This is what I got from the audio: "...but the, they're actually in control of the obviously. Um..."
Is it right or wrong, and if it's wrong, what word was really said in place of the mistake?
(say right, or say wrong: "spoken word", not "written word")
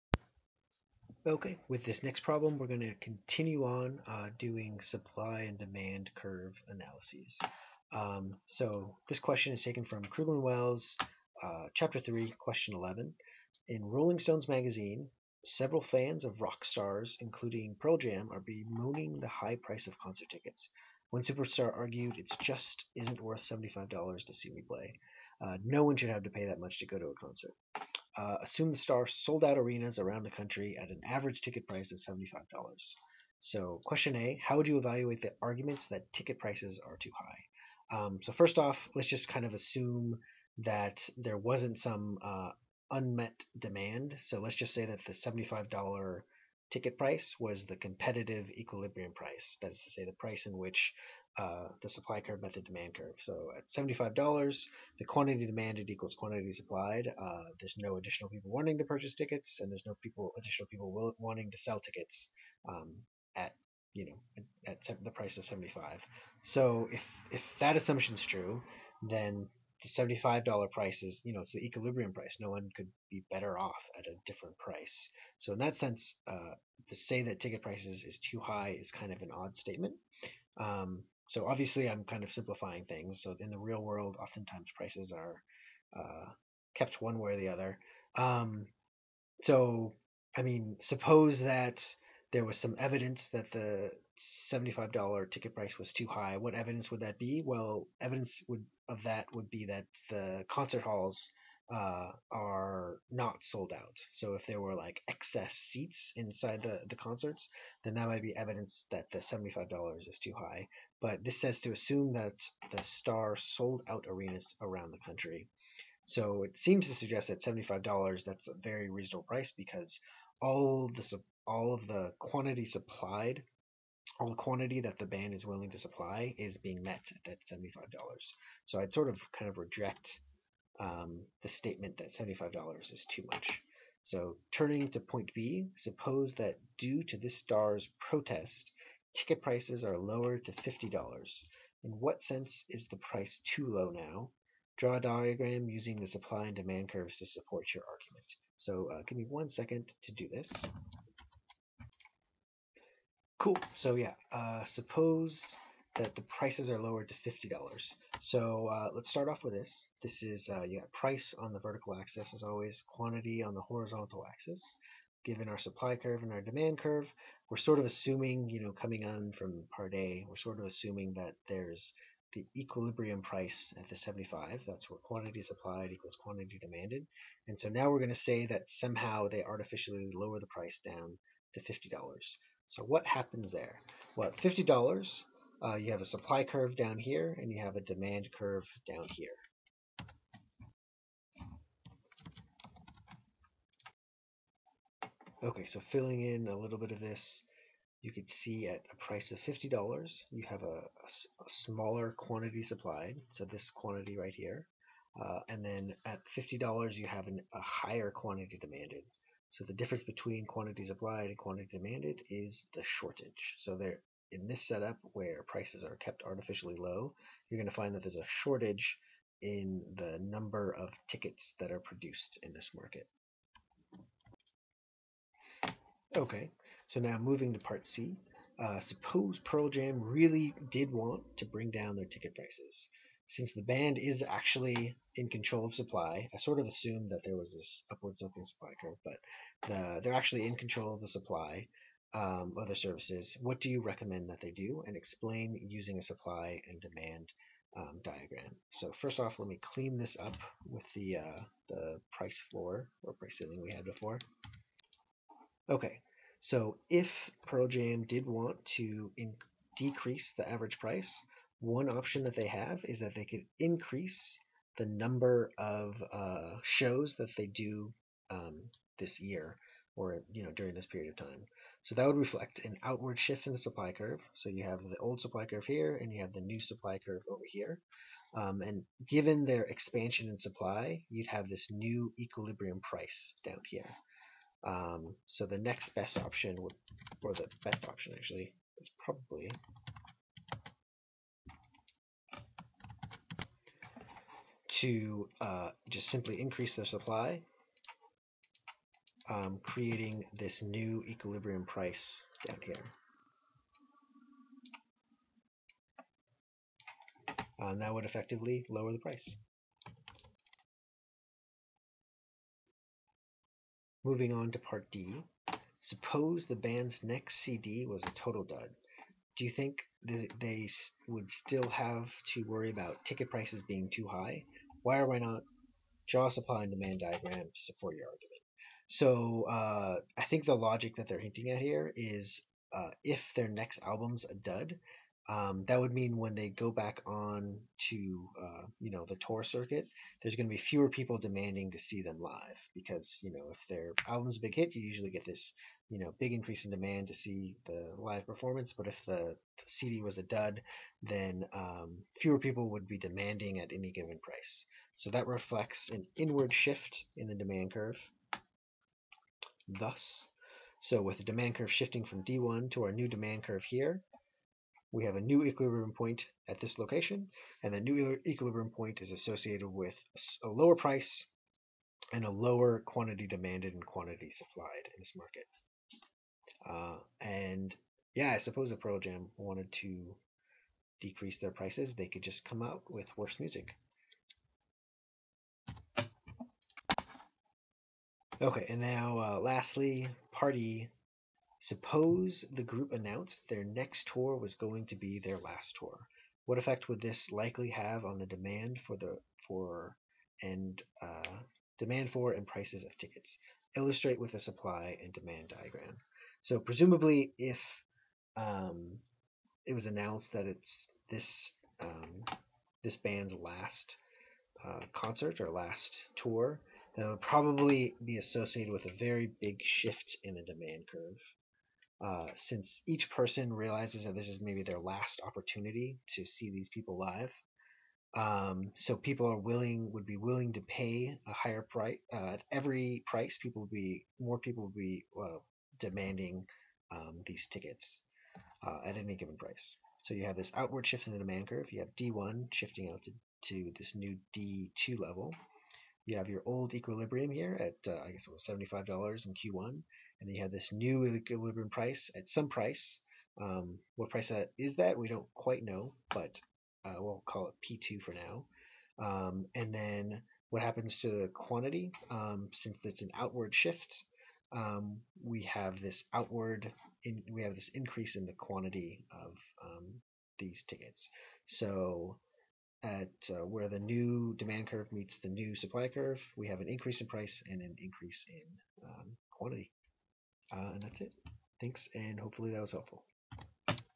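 wrong: "supply", not "obviously".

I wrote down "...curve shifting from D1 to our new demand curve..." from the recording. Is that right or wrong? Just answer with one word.
right.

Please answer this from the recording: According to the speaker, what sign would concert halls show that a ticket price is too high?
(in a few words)
not sold out.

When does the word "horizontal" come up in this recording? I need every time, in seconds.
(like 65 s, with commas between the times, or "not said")
163 s.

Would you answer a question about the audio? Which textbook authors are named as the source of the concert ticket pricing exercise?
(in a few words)
Krugman Wells.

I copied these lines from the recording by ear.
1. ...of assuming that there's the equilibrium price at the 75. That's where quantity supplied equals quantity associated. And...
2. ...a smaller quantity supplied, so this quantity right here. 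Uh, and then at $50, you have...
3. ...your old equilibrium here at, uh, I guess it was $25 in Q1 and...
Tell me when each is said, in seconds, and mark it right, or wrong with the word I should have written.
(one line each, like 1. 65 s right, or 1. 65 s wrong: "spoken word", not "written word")
1. 170 s wrong: "demanded", not "associated"
2. 200 s right
3. 446 s wrong: "75", not "25".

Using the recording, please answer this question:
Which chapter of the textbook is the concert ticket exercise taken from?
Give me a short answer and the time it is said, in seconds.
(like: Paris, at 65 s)
Chapter 3, at 11 s.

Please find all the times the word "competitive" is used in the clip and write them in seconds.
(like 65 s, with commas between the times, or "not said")
47 s.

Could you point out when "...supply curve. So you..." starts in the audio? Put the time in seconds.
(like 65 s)
273 s.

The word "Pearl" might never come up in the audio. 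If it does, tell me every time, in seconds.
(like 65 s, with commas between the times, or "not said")
17 s, 229 s, 257 s, 378 s.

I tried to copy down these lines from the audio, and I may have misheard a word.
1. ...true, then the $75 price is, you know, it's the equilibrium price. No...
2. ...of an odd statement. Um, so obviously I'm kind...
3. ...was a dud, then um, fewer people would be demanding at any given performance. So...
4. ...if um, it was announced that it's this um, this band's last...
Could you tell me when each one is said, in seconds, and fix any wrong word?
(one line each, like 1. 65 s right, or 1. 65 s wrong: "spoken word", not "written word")
1. 68 s right
2. 79 s right
3. 350 s wrong: "price", not "performance"
4. 407 s right.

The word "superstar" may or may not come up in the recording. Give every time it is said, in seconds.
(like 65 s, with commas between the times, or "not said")
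21 s.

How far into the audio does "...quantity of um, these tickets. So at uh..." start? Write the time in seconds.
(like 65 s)
468 s.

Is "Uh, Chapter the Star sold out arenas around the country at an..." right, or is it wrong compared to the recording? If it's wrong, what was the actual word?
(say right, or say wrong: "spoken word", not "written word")
wrong: "Assume", not "Chapter".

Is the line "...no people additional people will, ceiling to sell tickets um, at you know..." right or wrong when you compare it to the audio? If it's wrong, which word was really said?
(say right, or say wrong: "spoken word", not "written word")
wrong: "wanting", not "ceiling".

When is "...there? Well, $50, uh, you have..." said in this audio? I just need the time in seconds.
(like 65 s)
183 s.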